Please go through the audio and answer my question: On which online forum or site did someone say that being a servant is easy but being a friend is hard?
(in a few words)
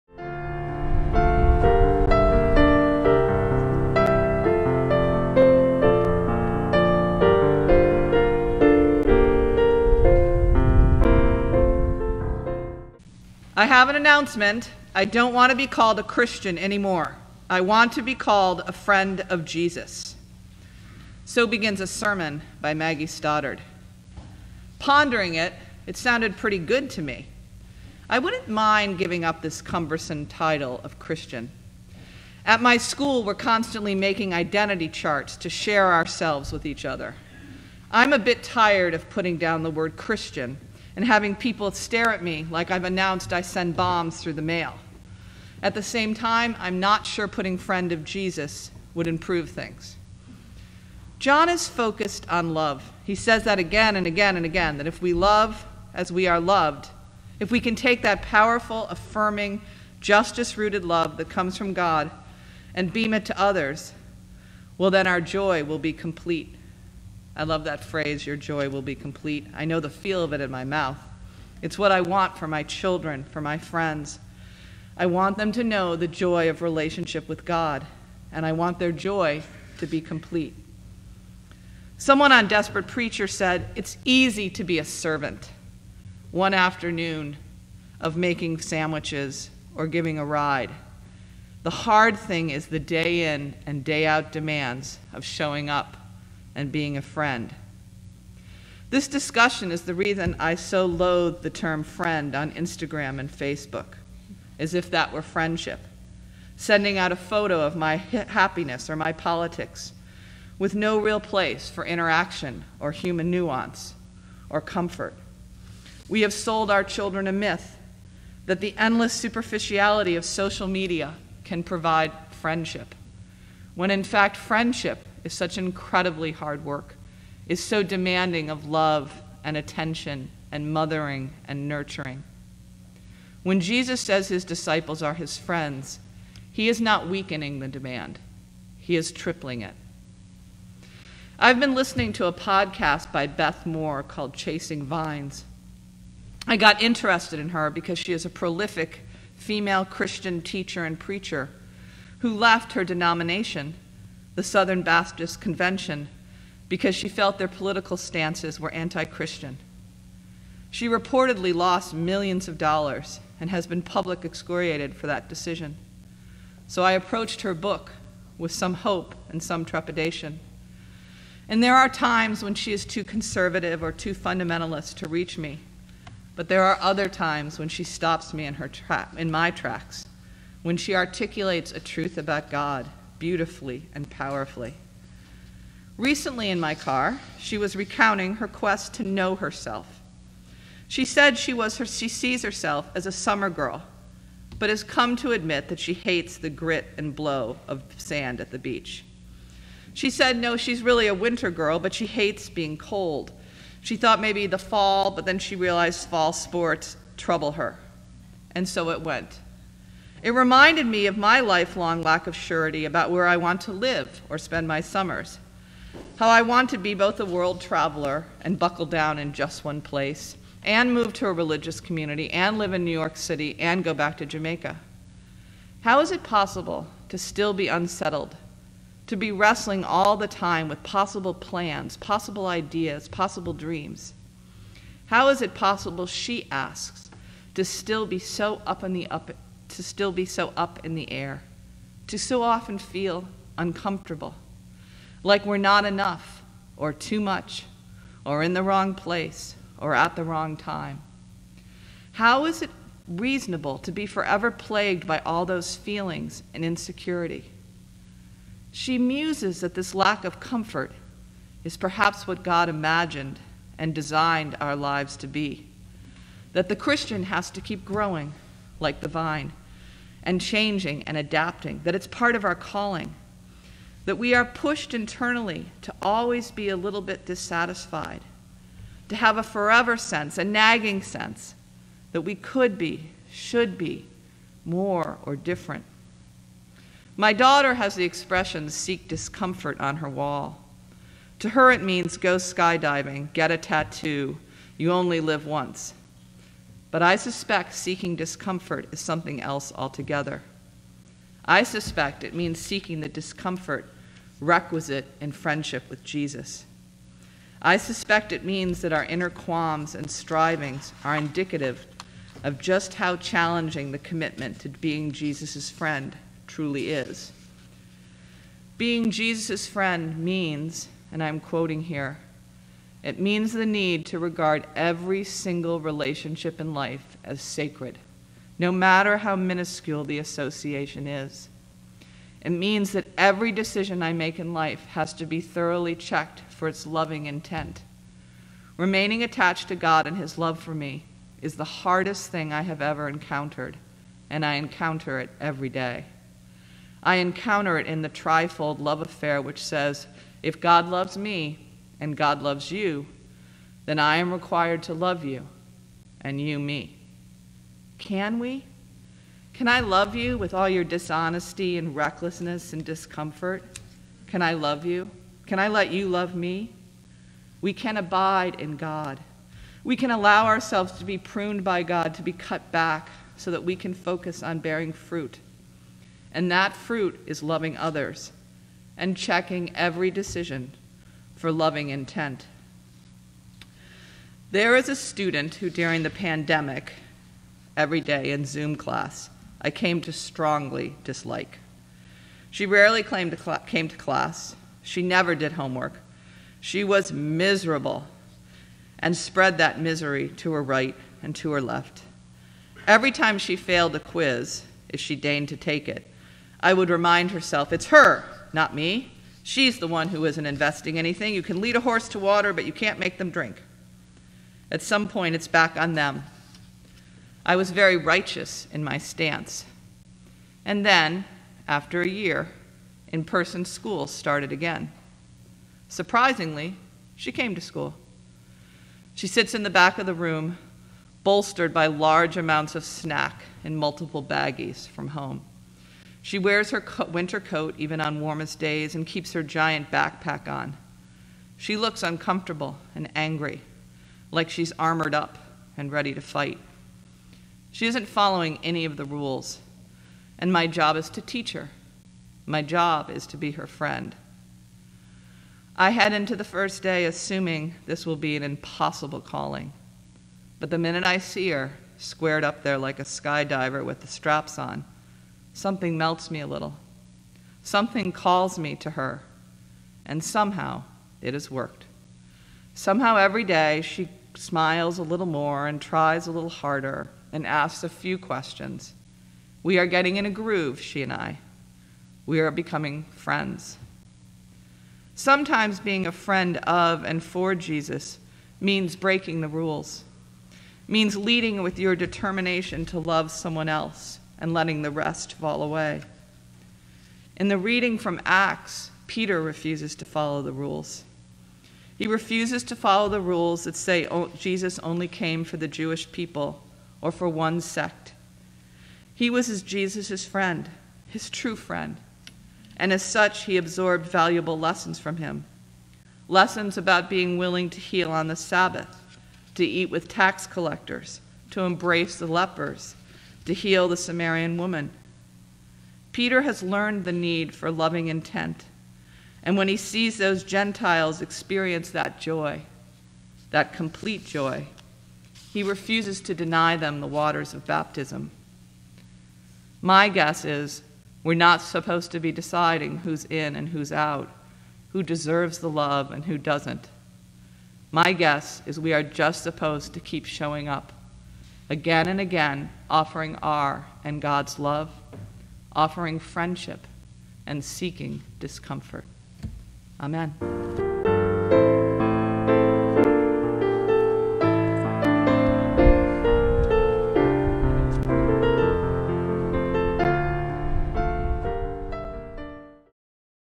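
Desperate Preacher.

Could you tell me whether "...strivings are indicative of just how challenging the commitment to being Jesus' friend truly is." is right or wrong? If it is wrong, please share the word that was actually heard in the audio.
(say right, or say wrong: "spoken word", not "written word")
right.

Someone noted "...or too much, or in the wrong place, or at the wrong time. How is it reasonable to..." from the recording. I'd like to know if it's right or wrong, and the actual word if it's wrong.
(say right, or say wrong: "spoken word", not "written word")
right.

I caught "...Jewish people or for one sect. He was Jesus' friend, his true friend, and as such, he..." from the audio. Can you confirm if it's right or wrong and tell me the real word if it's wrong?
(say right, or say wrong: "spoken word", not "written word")
right.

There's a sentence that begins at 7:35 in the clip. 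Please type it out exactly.
I head into the first day assuming this will be an impossible calling.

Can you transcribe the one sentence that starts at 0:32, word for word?
At my school, we're constantly making identity charts to share ourselves with each other.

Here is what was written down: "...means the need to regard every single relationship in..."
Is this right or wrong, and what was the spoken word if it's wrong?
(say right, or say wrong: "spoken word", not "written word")
right.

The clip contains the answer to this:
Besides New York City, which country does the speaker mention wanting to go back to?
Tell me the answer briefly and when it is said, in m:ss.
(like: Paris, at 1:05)
Jamaica, at 3:44.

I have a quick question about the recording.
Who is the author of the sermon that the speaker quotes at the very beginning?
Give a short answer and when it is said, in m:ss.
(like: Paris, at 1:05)
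Maggie Stoddard, at 0:22.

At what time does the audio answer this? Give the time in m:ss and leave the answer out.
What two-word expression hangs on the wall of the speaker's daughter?
4:48.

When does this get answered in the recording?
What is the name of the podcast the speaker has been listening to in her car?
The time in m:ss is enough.
2:24.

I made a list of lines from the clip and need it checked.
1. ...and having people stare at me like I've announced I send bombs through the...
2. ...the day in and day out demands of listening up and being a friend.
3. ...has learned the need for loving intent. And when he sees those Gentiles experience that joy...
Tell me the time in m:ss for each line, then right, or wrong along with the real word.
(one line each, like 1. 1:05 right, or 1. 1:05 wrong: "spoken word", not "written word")
1. 0:40 right
2. 1:32 wrong: "showing", not "listening"
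3. 8:46 right.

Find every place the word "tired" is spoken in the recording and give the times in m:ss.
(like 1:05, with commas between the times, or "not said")
0:38.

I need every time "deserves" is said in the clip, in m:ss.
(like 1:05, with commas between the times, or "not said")
9:05.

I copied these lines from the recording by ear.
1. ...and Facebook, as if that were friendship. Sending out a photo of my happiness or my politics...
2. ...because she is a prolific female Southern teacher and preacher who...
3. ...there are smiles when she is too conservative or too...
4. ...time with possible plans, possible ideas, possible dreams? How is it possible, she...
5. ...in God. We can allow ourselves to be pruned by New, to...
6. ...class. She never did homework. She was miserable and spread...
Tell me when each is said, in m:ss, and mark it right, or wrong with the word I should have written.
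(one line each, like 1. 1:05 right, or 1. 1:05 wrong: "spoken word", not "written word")
1. 1:43 right
2. 2:27 wrong: "Christian", not "Southern"
3. 2:51 wrong: "times", not "smiles"
4. 3:50 right
5. 6:08 wrong: "God", not "New"
6. 6:33 right.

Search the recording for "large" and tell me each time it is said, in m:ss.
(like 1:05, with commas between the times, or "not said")
7:11.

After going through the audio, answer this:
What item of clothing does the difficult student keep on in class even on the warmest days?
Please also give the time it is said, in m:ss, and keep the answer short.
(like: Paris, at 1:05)
Winter coat, at 7:17.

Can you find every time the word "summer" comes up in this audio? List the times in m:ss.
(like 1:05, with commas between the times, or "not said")
3:13, 3:34.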